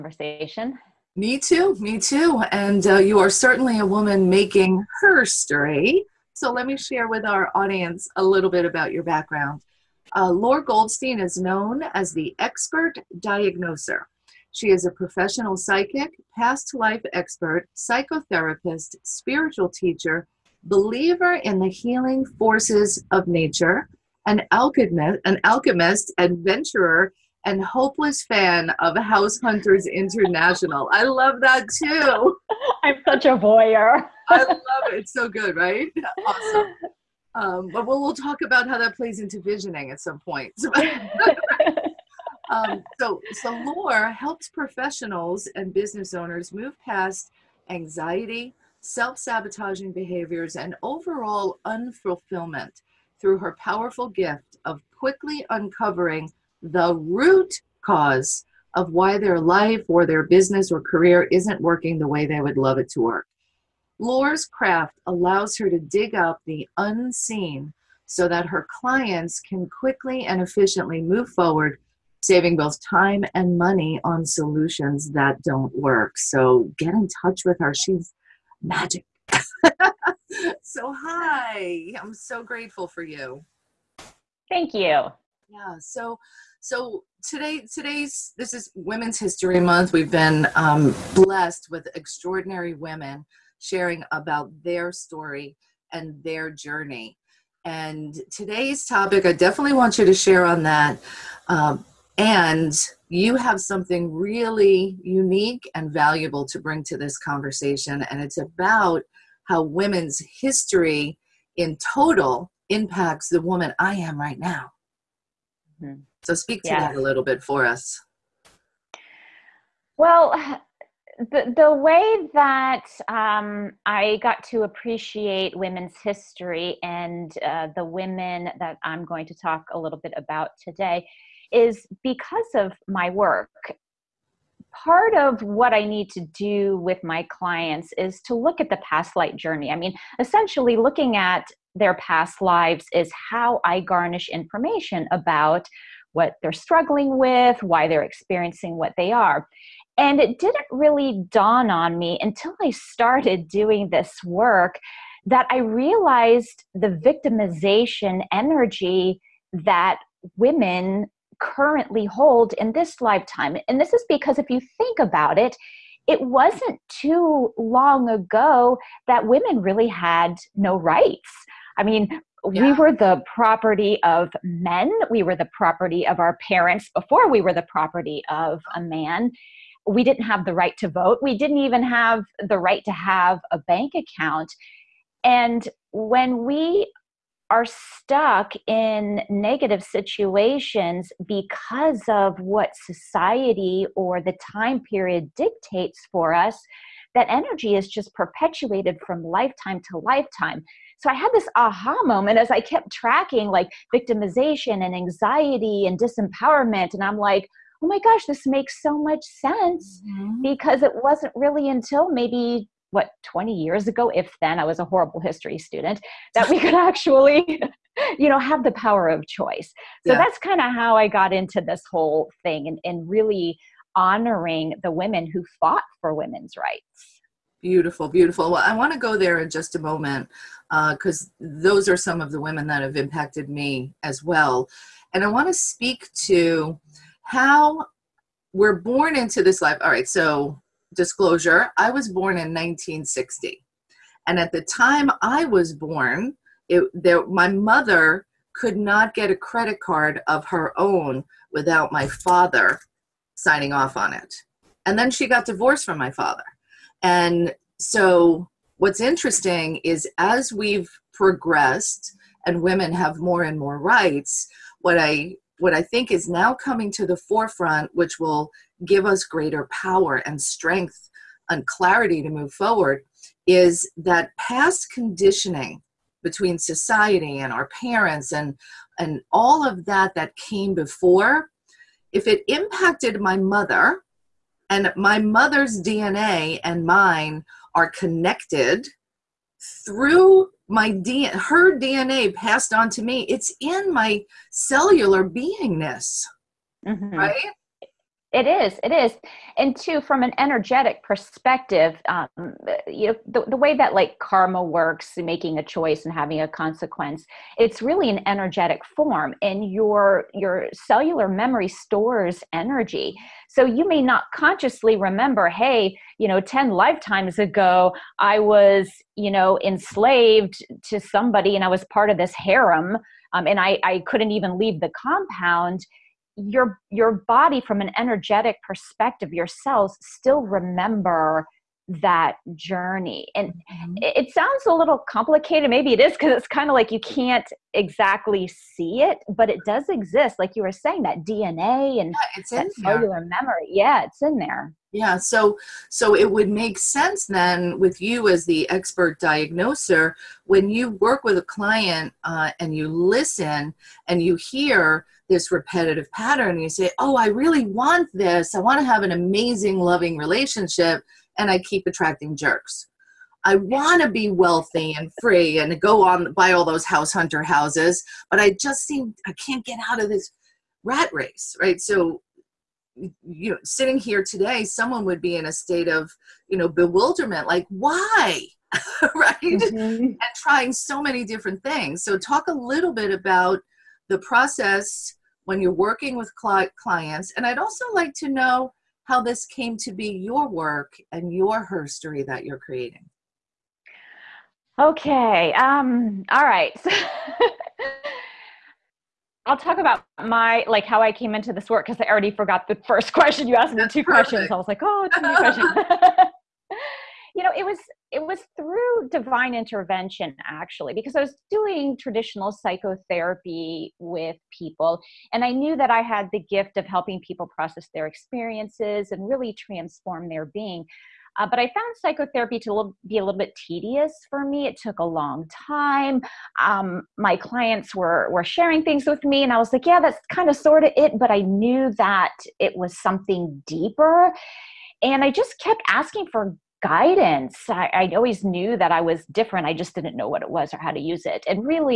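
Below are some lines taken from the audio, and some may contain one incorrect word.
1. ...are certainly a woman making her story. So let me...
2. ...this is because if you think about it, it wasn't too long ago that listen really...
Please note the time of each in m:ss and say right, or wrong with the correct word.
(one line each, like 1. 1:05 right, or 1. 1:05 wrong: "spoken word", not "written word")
1. 0:03 right
2. 2:43 wrong: "women", not "listen".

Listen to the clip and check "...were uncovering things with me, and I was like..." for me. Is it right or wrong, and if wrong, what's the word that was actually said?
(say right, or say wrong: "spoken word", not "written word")
wrong: "sharing", not "uncovering".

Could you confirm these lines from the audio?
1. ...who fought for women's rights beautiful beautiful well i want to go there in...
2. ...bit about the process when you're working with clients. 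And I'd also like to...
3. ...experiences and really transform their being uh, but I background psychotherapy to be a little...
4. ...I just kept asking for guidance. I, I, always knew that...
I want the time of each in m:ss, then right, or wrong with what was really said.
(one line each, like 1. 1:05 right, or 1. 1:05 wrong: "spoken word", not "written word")
1. 3:45 right
2. 6:22 right
3. 6:58 wrong: "found", not "background"
4. 7:15 right.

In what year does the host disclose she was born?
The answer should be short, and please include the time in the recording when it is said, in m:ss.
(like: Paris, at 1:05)
1960, at 4:02.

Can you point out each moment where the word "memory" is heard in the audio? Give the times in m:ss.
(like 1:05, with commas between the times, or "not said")
5:11, 5:43.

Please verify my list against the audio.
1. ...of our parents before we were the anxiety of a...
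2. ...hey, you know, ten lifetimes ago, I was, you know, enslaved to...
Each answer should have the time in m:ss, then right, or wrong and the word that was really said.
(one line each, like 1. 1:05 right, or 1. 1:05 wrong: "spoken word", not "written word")
1. 2:56 wrong: "property", not "anxiety"
2. 5:15 right.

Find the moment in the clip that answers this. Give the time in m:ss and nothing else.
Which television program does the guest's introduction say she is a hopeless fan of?
0:28.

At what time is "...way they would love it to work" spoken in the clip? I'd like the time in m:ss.
1:02.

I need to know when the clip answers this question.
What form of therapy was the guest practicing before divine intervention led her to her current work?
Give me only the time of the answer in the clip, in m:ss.
6:51.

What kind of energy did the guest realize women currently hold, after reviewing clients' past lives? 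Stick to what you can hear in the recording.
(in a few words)
Victimization energy.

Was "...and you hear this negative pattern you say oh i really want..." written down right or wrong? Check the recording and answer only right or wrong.
wrong.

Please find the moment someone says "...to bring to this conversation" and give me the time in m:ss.
1:46.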